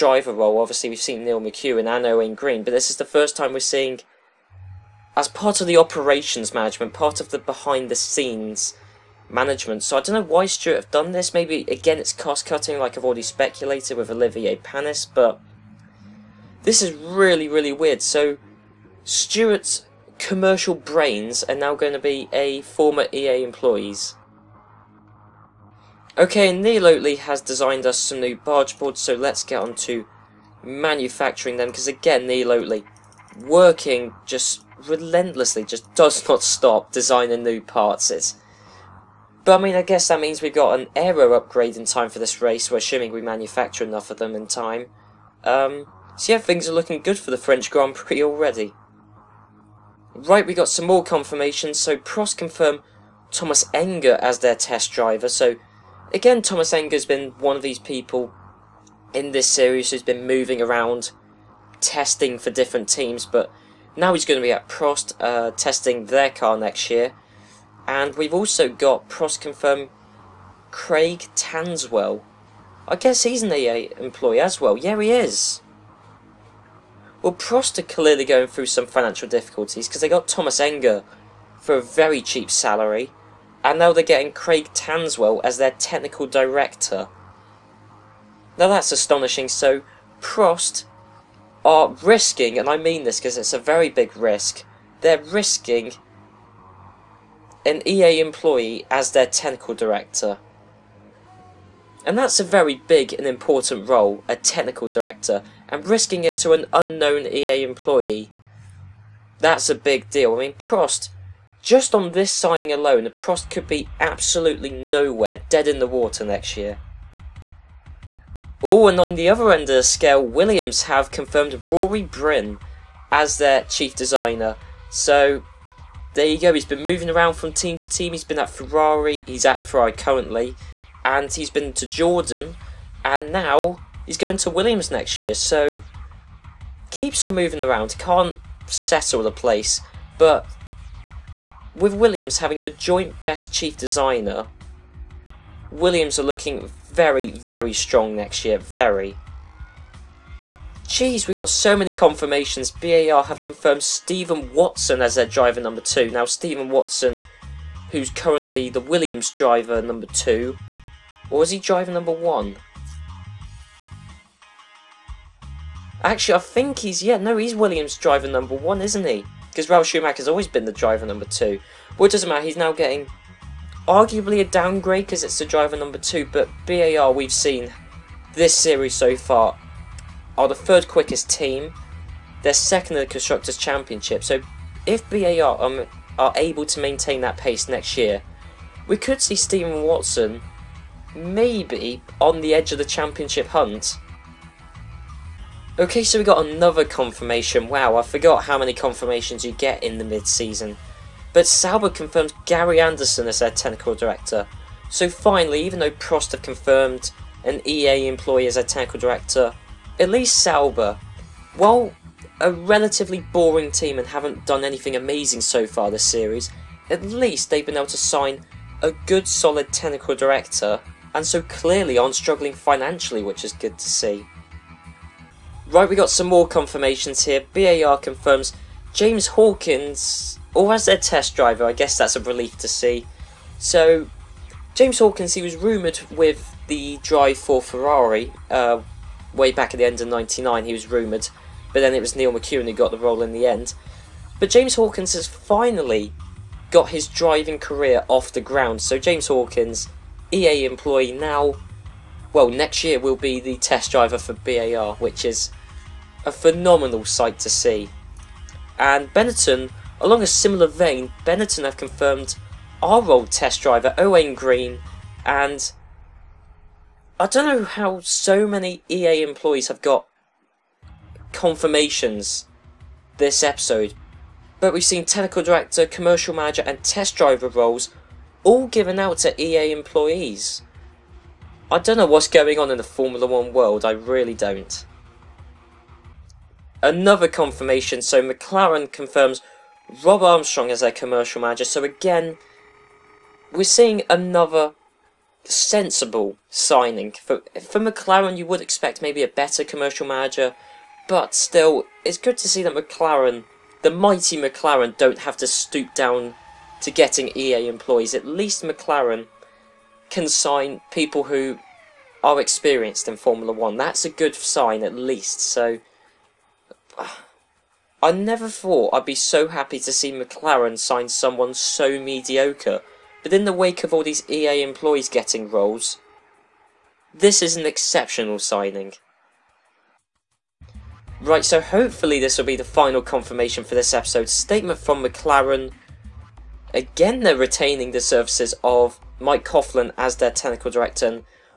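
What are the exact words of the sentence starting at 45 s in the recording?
Um, so yeah, things are looking good for the French Grand Prix already.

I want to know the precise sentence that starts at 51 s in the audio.
So Prost confirmed Thomas Enge as their test driver.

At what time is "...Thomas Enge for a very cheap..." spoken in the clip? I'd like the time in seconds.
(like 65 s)
80 s.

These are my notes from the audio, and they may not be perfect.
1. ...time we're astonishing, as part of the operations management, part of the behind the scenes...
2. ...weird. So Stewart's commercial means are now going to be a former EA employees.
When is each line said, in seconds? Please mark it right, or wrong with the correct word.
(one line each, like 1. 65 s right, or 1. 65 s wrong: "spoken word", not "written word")
1. 3 s wrong: "seeing", not "astonishing"
2. 17 s wrong: "brains", not "means".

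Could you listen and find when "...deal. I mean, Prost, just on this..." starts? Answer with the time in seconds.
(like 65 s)
110 s.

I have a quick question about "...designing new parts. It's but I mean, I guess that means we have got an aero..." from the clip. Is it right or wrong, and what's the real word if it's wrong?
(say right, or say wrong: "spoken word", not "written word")
right.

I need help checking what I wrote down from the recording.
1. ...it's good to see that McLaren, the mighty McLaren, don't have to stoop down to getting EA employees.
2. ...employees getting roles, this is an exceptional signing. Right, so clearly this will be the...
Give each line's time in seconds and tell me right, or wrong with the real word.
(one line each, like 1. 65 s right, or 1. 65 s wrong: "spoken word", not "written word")
1. 302 s right
2. 324 s wrong: "hopefully", not "clearly".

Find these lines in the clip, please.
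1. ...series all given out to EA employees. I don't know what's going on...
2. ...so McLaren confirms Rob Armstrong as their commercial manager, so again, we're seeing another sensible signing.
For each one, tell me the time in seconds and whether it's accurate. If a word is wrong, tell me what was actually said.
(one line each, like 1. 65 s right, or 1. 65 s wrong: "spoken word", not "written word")
1. 277 s wrong: "roles", not "series"
2. 288 s right.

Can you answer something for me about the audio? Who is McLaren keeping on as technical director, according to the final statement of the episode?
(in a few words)
Mike Coughlan.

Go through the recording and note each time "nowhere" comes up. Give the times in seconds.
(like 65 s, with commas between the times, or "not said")
114 s.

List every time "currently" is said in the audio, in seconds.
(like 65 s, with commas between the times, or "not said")
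129 s, 158 s.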